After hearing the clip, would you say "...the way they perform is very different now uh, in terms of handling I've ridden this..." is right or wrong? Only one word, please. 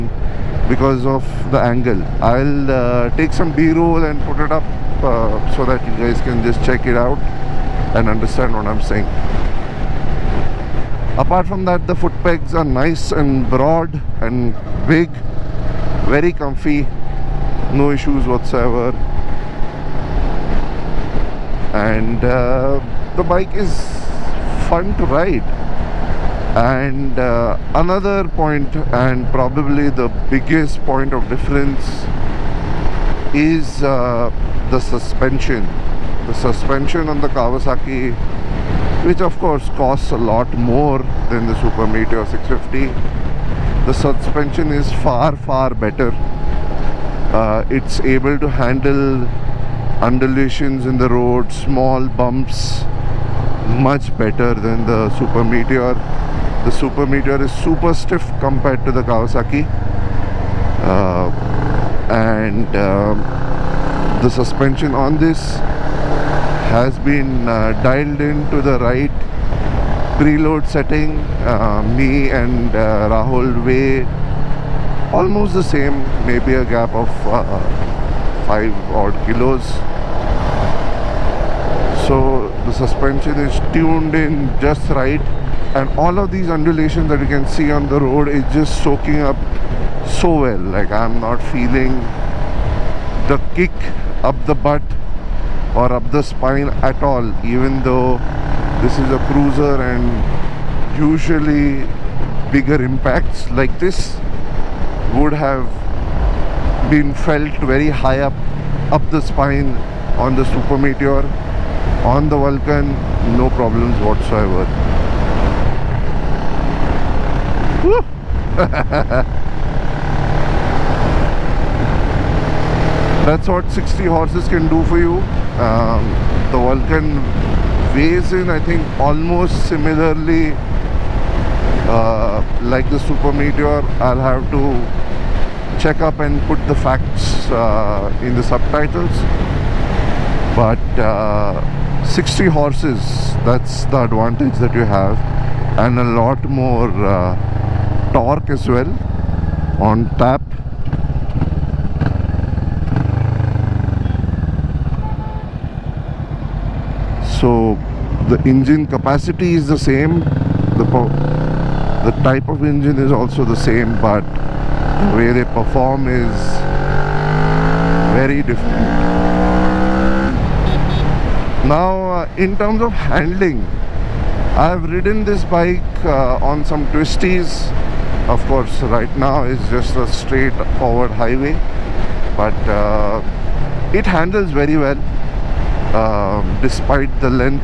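right.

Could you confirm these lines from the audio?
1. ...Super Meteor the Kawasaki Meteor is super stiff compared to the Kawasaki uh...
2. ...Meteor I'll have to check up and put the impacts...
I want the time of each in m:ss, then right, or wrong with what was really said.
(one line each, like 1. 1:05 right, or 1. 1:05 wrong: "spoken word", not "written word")
1. 0:55 wrong: "Super", not "Kawasaki"
2. 2:13 wrong: "facts", not "impacts".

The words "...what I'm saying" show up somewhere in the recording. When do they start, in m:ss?
0:08.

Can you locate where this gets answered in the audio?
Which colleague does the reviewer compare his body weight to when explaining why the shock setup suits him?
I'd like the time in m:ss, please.
1:13.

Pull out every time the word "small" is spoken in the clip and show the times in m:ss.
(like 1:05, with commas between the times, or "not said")
0:51.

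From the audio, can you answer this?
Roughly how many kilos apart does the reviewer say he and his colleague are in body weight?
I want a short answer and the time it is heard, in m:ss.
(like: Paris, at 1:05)
5, at 1:17.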